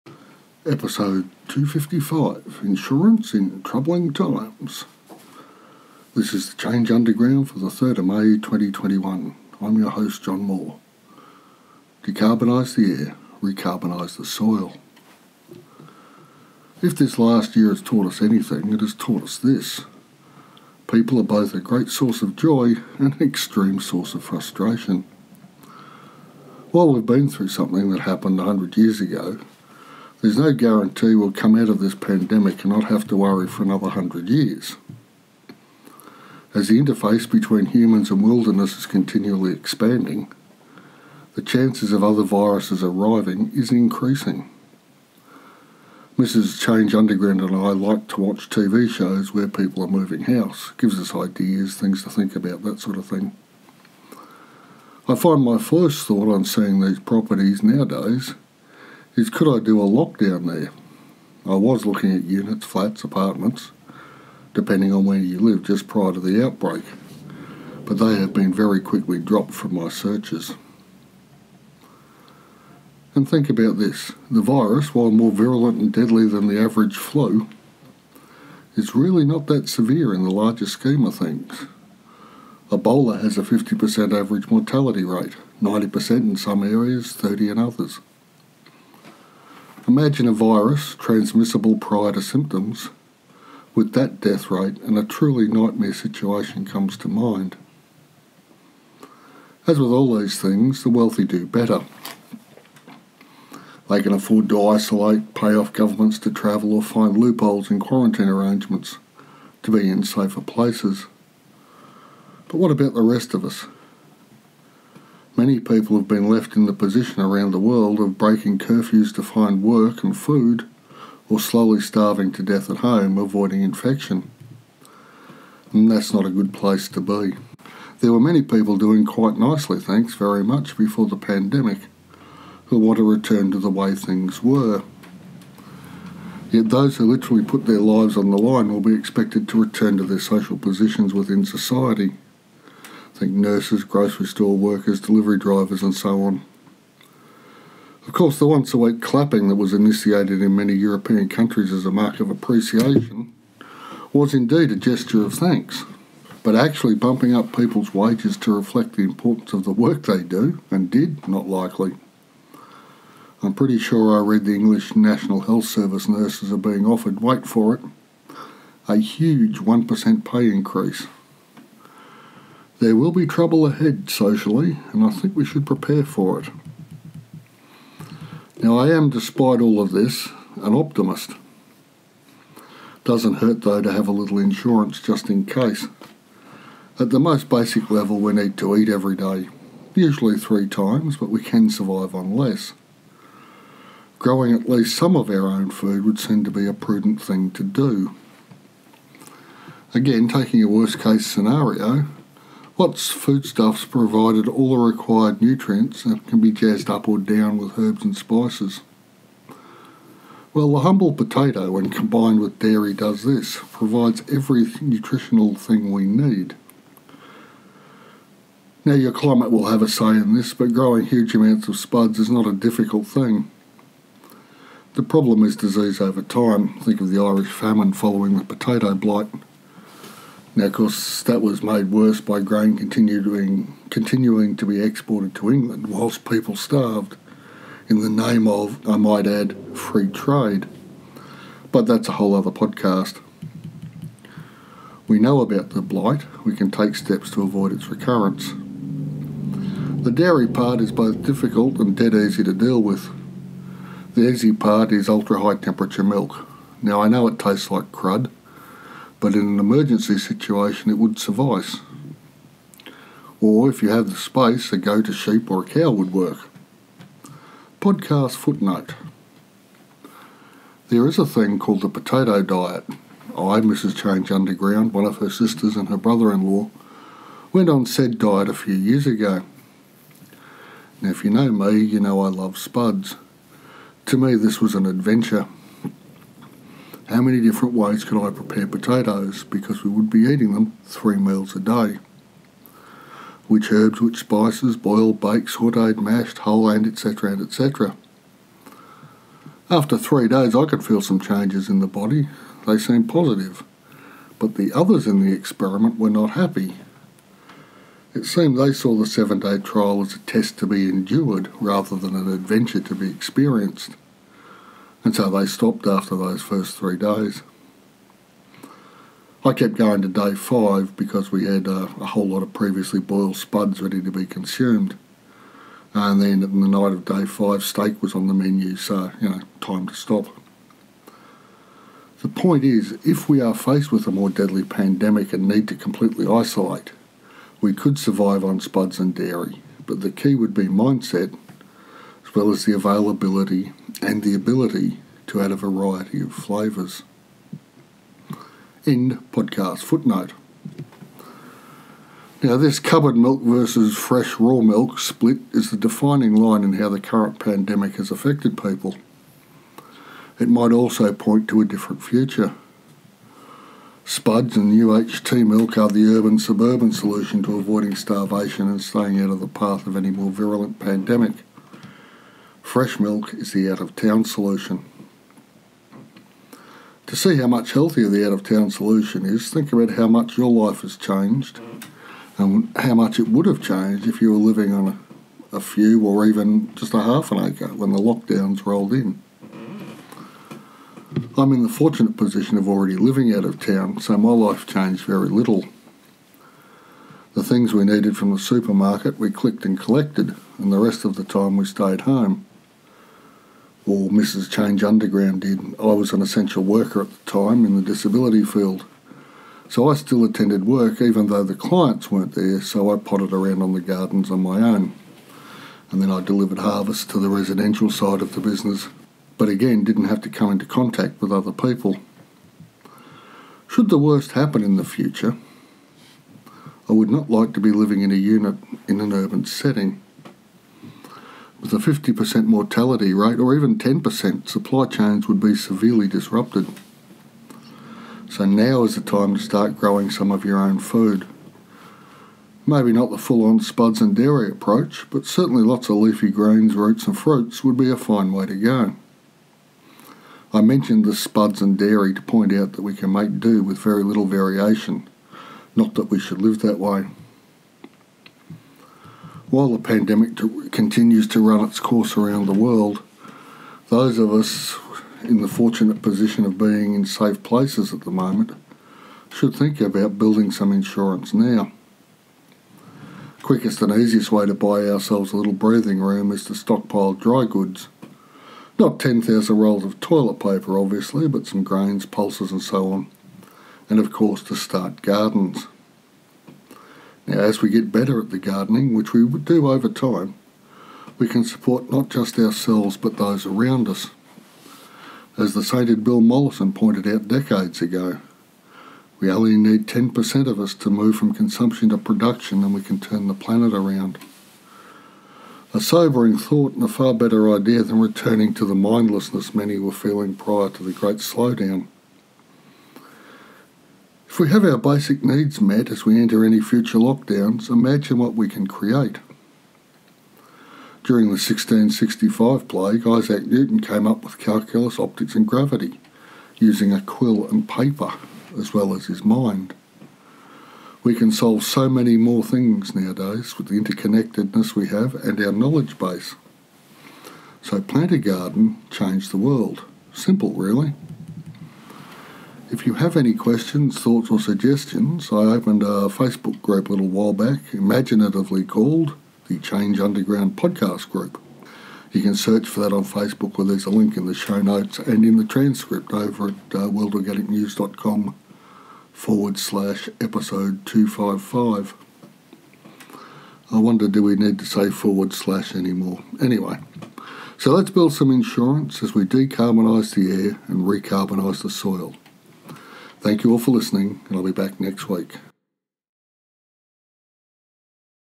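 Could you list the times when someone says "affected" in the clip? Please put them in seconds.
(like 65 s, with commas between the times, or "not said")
358 s.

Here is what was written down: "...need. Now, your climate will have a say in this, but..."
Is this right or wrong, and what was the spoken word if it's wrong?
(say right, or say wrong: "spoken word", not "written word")
right.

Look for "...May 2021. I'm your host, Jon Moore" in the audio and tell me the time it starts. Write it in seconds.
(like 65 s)
8 s.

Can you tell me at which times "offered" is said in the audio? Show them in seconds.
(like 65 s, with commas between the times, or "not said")
166 s.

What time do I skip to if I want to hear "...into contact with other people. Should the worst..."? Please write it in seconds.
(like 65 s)
420 s.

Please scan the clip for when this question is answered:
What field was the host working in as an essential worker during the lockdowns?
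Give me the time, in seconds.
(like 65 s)
407 s.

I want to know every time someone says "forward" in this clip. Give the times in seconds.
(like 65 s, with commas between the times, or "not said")
559 s, 564 s.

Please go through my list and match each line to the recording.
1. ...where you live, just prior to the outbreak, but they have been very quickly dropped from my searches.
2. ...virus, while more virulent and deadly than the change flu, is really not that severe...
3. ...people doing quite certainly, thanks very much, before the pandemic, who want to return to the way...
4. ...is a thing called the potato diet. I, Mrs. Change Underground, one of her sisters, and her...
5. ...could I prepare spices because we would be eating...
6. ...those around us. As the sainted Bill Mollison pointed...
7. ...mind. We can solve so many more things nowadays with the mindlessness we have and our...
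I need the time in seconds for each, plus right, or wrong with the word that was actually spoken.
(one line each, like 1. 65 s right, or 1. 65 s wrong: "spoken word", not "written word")
1. 65 s right
2. 74 s wrong: "average", not "change"
3. 128 s wrong: "nicely", not "certainly"
4. 271 s right
5. 288 s wrong: "potatoes", not "spices"
6. 493 s right
7. 529 s wrong: "interconnectedness", not "mindlessness".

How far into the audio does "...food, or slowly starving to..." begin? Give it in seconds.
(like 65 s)
120 s.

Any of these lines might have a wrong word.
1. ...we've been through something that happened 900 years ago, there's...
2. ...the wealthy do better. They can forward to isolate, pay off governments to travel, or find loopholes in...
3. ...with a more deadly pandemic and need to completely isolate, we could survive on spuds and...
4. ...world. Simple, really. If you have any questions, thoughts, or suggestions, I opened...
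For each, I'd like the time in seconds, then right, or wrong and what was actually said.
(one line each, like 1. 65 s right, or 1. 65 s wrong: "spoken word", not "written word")
1. 26 s wrong: "100", not "900"
2. 100 s wrong: "afford", not "forward"
3. 333 s right
4. 539 s right.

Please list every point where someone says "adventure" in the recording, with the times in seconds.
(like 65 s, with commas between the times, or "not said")
284 s, 312 s.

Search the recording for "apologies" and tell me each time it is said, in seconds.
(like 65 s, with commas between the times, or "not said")
not said.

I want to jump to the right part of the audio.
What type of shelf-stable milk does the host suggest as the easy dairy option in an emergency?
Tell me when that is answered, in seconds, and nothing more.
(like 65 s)
255 s.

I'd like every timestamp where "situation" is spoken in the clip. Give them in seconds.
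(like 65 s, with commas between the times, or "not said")
95 s, 260 s.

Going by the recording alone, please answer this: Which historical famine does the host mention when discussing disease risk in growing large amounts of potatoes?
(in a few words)
Irish famine.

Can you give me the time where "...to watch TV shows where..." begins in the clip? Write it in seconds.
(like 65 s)
48 s.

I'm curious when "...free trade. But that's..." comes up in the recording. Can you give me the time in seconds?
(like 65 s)
239 s.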